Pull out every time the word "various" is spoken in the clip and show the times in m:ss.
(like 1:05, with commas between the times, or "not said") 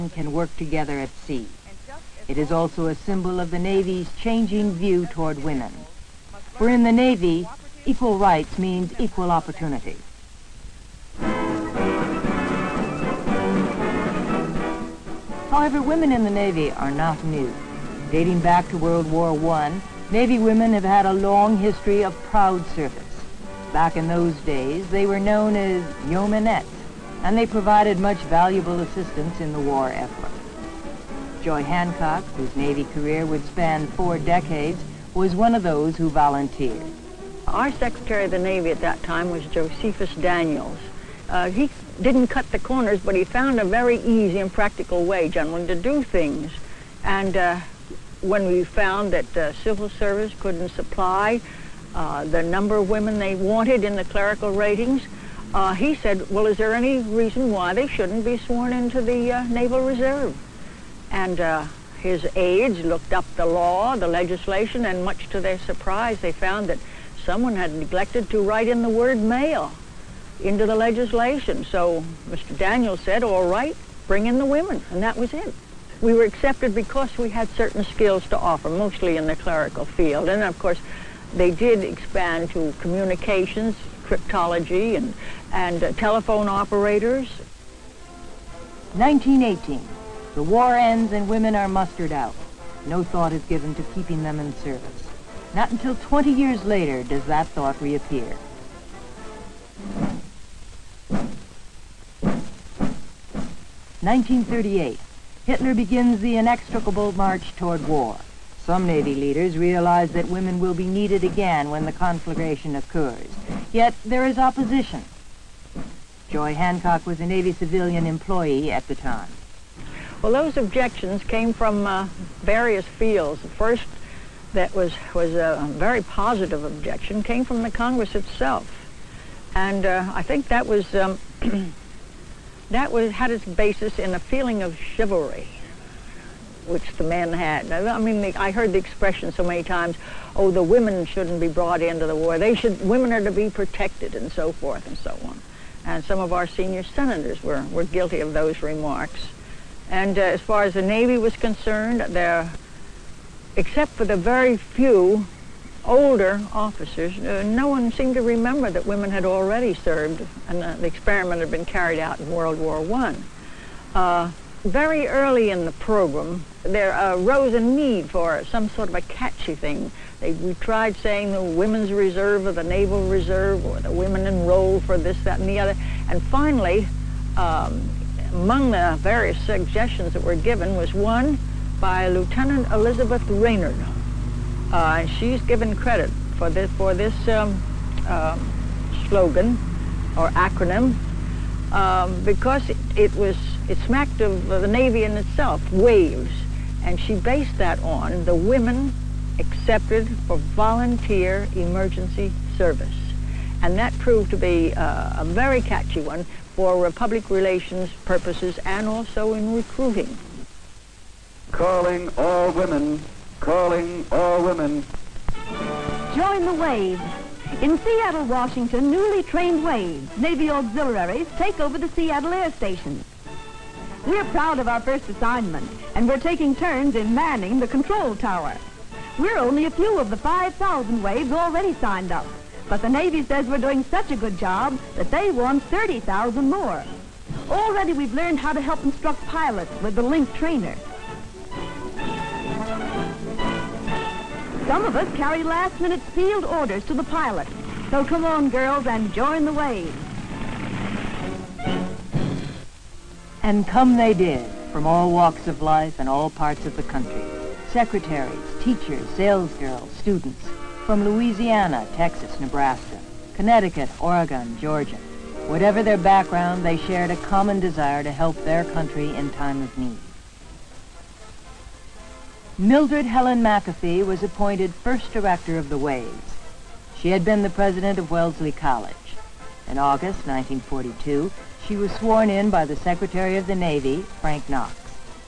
2:02, 2:59.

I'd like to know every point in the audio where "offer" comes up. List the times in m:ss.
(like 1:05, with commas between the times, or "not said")
1:18.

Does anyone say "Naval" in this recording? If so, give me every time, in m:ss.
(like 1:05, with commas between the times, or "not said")
0:59, 2:52.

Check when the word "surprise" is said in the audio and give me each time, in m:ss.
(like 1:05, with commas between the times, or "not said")
1:05.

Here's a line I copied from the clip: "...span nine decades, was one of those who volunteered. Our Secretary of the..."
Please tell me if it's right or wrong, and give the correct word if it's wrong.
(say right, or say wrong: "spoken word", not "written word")
wrong: "four", not "nine".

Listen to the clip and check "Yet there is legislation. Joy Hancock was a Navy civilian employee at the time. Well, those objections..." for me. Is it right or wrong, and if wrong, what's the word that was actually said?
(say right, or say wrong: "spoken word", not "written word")
wrong: "opposition", not "legislation".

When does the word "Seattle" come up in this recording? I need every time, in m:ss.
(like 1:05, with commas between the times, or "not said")
3:37, 3:41.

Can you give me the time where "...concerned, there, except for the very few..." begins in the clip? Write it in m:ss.
2:31.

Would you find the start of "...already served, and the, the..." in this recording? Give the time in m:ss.
2:39.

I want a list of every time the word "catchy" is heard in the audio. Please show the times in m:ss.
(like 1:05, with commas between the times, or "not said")
2:49, 3:25.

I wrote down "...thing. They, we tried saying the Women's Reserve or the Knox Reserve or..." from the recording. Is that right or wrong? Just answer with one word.
wrong.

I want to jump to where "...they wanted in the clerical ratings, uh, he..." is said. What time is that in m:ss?
0:53.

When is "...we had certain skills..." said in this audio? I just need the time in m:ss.
1:17.